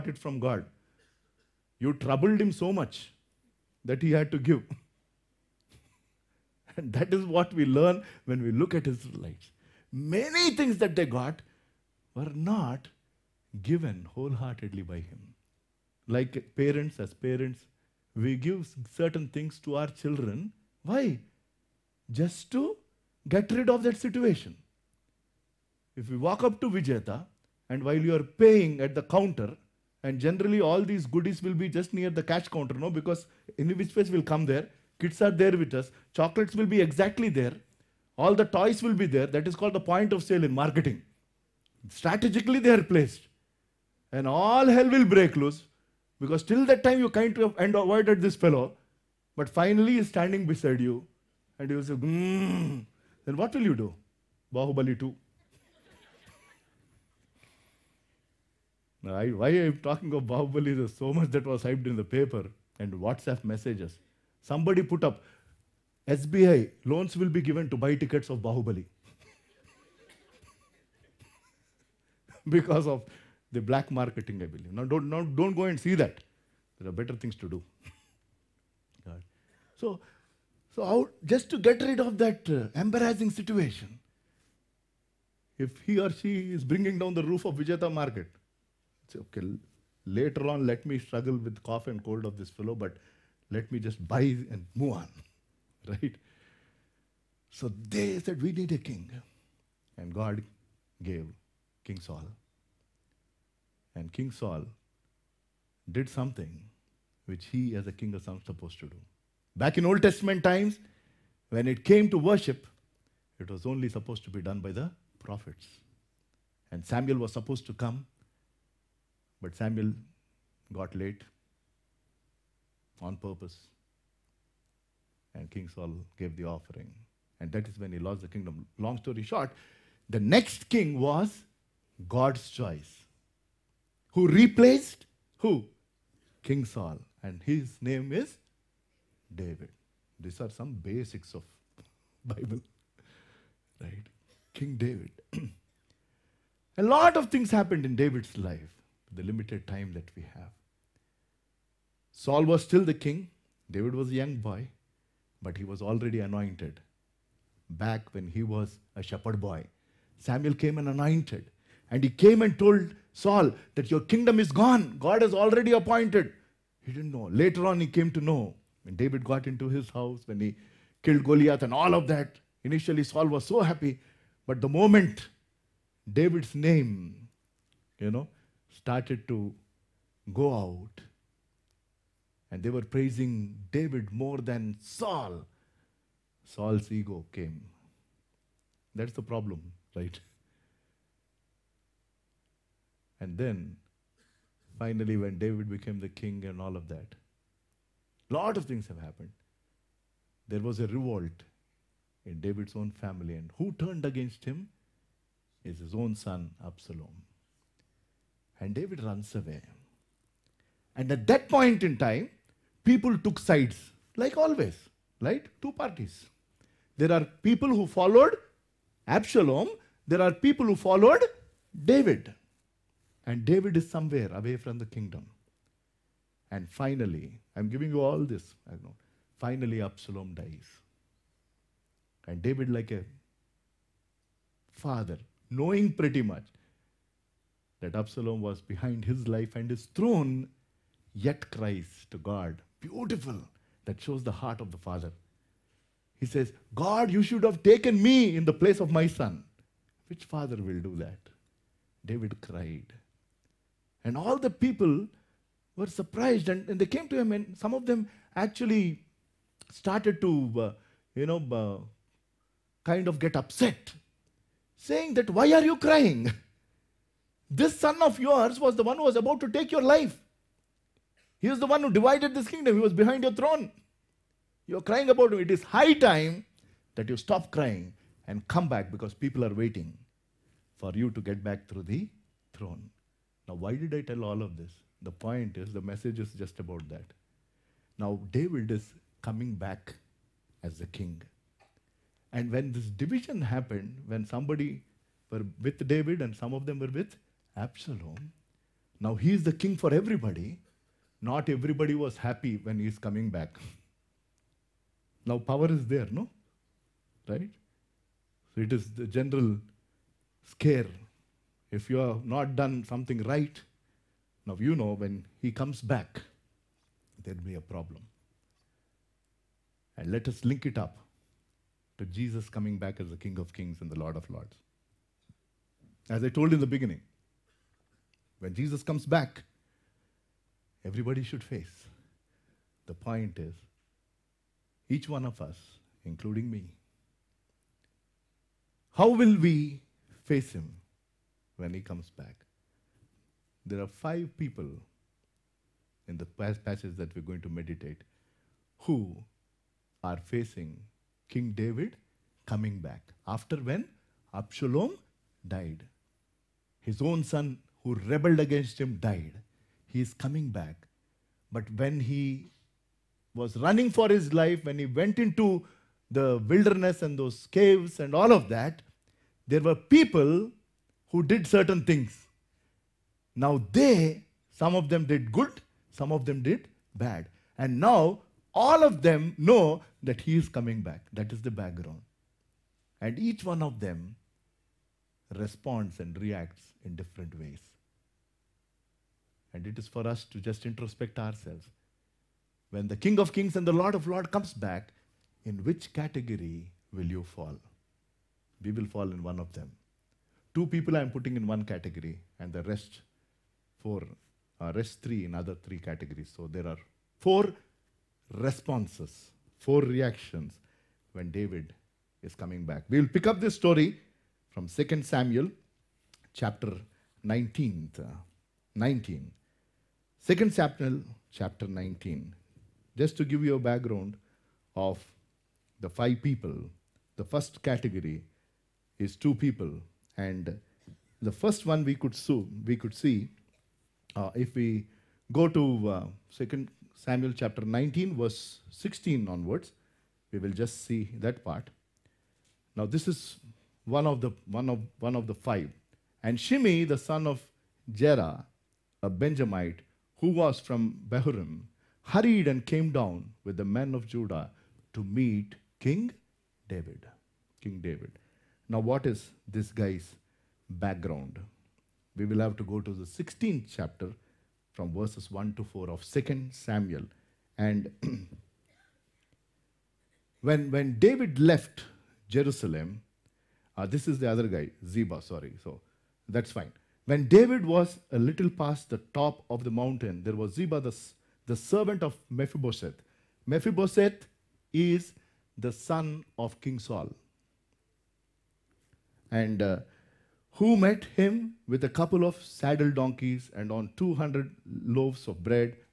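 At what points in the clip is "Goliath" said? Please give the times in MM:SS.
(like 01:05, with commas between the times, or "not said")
02:51.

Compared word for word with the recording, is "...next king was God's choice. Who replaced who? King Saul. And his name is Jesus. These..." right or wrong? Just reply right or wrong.
wrong.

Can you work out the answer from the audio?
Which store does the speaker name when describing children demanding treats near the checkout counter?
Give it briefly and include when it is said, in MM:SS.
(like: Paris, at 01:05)
Vijetha, at 00:26.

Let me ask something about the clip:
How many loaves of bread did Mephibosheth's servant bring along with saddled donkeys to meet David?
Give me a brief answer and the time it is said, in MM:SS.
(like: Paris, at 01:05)
200, at 08:13.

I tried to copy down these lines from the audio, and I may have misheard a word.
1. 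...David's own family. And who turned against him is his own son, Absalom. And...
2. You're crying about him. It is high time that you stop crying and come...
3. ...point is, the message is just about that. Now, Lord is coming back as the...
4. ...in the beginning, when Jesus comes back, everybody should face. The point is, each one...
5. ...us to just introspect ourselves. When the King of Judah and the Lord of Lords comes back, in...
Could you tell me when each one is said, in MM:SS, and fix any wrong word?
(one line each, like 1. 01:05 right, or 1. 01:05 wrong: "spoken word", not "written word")
1. 03:22 right
2. 04:34 right
3. 04:45 wrong: "David", not "Lord"
4. 05:26 right
5. 06:30 wrong: "Kings", not "Judah".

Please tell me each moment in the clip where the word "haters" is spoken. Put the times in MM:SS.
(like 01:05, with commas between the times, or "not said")
not said.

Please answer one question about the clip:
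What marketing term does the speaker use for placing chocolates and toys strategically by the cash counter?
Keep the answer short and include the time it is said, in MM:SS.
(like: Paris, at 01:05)
point of sale, at 00:39.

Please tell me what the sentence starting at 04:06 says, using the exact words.
He says, God, you should have taken me in the place of my son.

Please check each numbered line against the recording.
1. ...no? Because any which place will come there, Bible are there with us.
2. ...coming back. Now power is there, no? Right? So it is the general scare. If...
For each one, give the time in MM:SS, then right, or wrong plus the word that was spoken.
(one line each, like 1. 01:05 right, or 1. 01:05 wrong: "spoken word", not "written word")
1. 00:32 wrong: "Kids", not "Bible"
2. 05:02 right.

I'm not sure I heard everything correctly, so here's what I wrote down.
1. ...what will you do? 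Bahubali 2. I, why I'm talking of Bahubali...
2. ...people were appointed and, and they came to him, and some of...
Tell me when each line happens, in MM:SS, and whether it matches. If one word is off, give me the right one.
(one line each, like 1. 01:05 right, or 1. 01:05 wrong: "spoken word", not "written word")
1. 00:53 right
2. 04:14 wrong: "surprised", not "appointed".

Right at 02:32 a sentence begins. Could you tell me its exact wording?
Saul was still the king, David was a young boy, but he was already anointed back when he was a shepherd boy.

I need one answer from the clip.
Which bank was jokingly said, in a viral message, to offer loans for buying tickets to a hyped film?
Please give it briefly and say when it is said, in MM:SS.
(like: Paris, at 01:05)
SBI, at 01:06.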